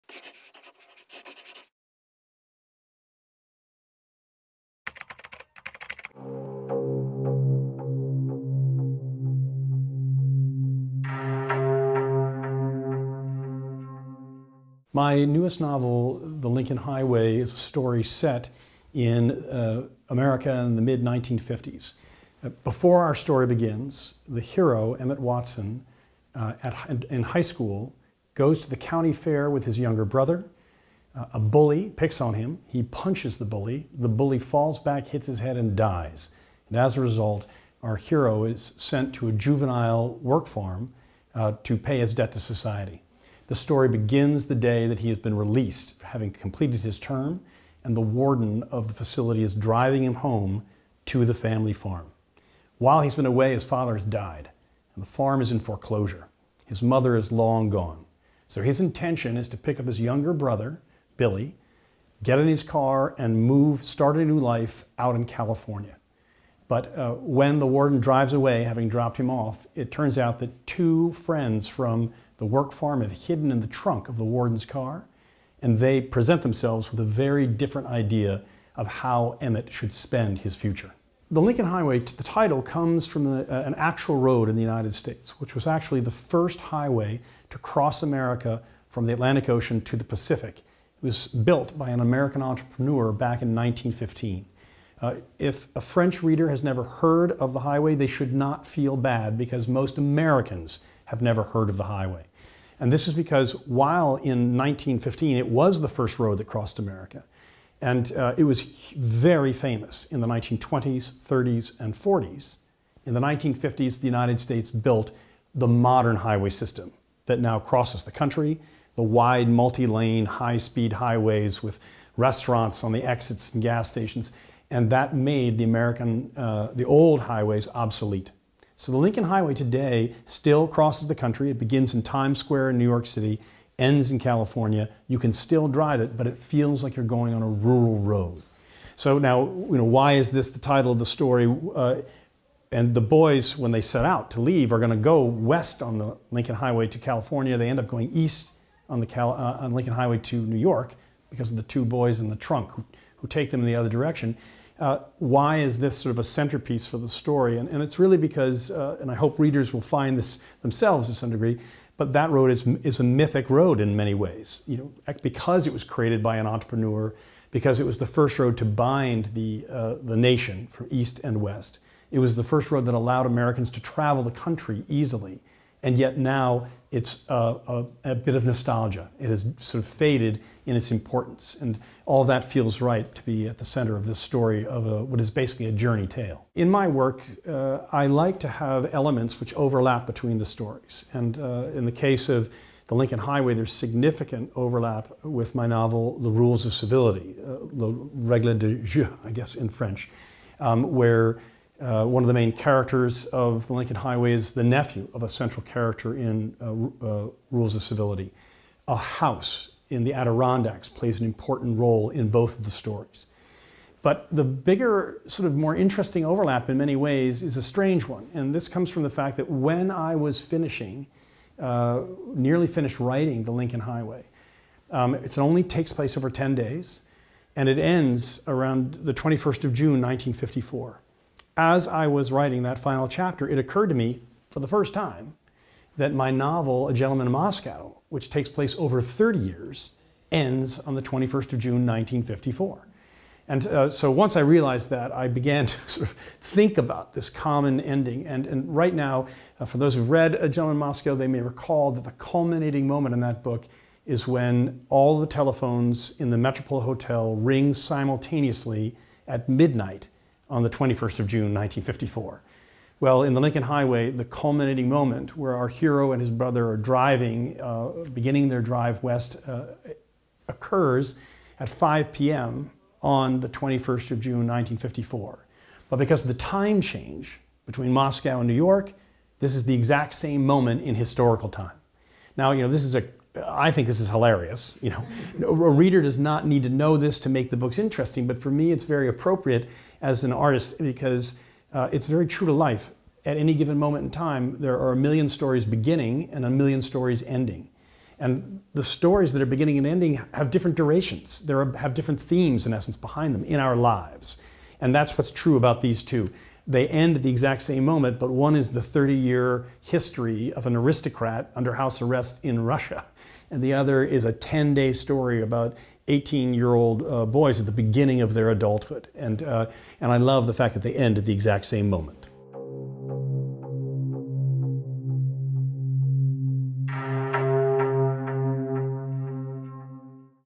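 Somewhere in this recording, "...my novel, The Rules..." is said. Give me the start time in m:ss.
3:15.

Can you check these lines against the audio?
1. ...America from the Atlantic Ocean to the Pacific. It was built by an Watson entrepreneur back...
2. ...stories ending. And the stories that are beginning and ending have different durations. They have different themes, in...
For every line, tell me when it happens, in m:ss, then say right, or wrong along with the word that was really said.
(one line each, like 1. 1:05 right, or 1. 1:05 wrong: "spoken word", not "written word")
1. 1:28 wrong: "American", not "Watson"
2. 4:56 right.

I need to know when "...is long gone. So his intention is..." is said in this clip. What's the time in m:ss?
0:57.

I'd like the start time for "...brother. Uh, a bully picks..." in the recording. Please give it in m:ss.
0:30.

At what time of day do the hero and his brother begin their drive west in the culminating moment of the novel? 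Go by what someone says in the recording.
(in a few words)
5 p.m.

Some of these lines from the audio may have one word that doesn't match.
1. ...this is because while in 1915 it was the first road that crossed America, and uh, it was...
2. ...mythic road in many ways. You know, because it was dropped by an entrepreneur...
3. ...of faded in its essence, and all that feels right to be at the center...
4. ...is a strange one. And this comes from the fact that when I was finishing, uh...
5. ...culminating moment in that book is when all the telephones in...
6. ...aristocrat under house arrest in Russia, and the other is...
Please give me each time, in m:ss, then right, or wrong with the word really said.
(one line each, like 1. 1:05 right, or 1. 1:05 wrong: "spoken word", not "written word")
1. 1:42 right
2. 2:43 wrong: "created", not "dropped"
3. 2:59 wrong: "importance", not "essence"
4. 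3:37 right
5. 4:12 right
6. 5:10 right.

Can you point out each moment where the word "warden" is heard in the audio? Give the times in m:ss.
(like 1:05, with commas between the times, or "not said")
0:47, 1:07, 1:14.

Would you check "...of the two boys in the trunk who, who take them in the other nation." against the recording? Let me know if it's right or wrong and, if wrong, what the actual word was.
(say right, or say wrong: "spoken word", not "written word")
wrong: "direction", not "nation".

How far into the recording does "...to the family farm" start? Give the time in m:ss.
0:51.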